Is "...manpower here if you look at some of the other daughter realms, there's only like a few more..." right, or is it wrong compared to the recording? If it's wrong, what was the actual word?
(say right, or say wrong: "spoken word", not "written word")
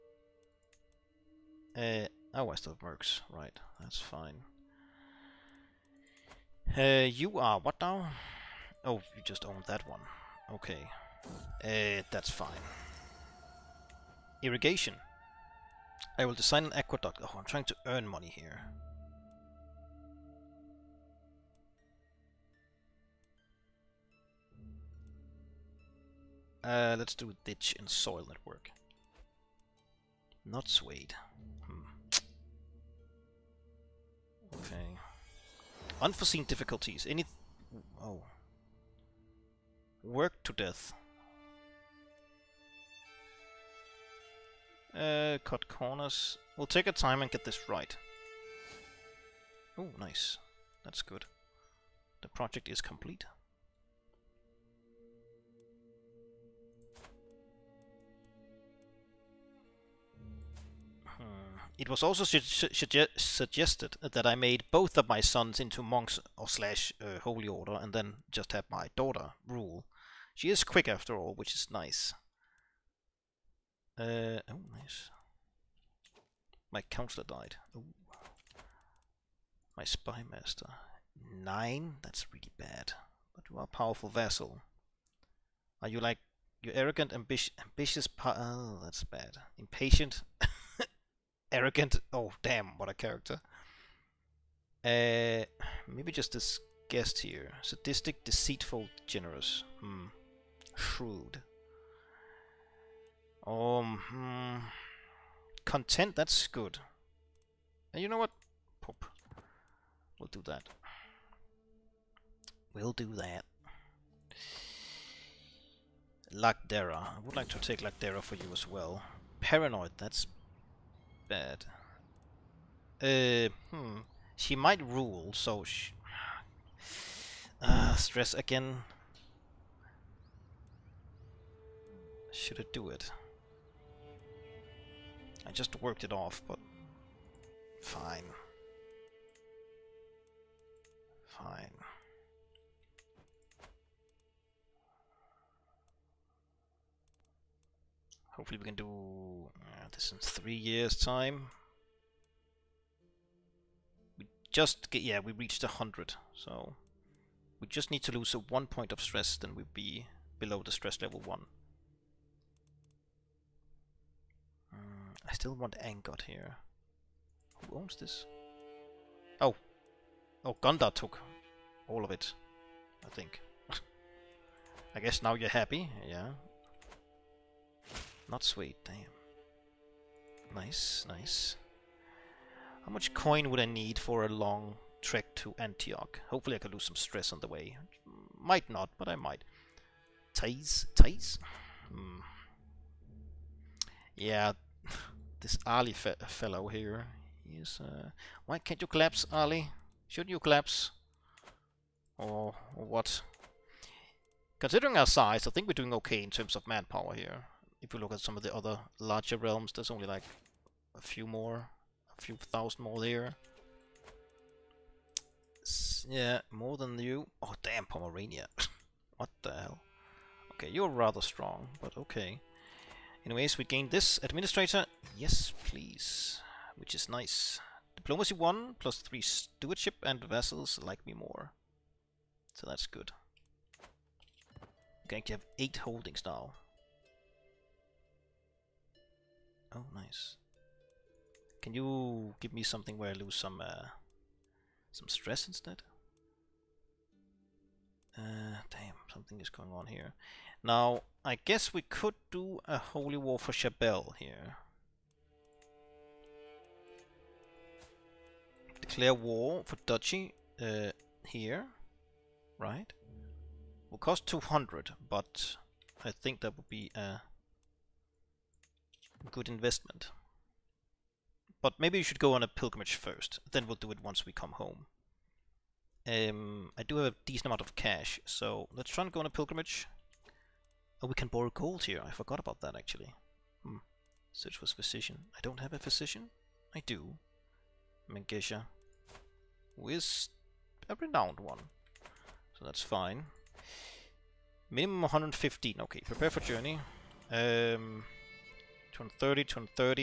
wrong: "larger", not "daughter".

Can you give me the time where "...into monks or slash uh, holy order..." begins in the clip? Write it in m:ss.
1:05.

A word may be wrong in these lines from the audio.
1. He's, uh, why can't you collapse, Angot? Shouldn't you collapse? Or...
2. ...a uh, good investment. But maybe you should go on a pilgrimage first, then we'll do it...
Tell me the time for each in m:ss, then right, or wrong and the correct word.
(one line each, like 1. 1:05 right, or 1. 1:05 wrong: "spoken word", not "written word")
1. 3:17 wrong: "Ali", not "Angot"
2. 4:26 right.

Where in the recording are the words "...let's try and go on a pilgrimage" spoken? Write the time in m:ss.
4:38.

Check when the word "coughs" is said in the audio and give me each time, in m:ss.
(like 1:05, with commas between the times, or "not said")
not said.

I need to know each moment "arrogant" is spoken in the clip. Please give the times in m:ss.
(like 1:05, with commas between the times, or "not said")
1:26, 1:31.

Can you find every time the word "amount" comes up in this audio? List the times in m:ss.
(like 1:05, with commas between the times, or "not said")
4:37.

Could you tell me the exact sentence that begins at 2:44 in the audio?
Mm, I still want Angot here.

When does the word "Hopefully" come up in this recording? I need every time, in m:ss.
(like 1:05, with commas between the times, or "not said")
2:28, 3:06.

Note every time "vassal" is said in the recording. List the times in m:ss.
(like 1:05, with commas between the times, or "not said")
1:24, 3:50.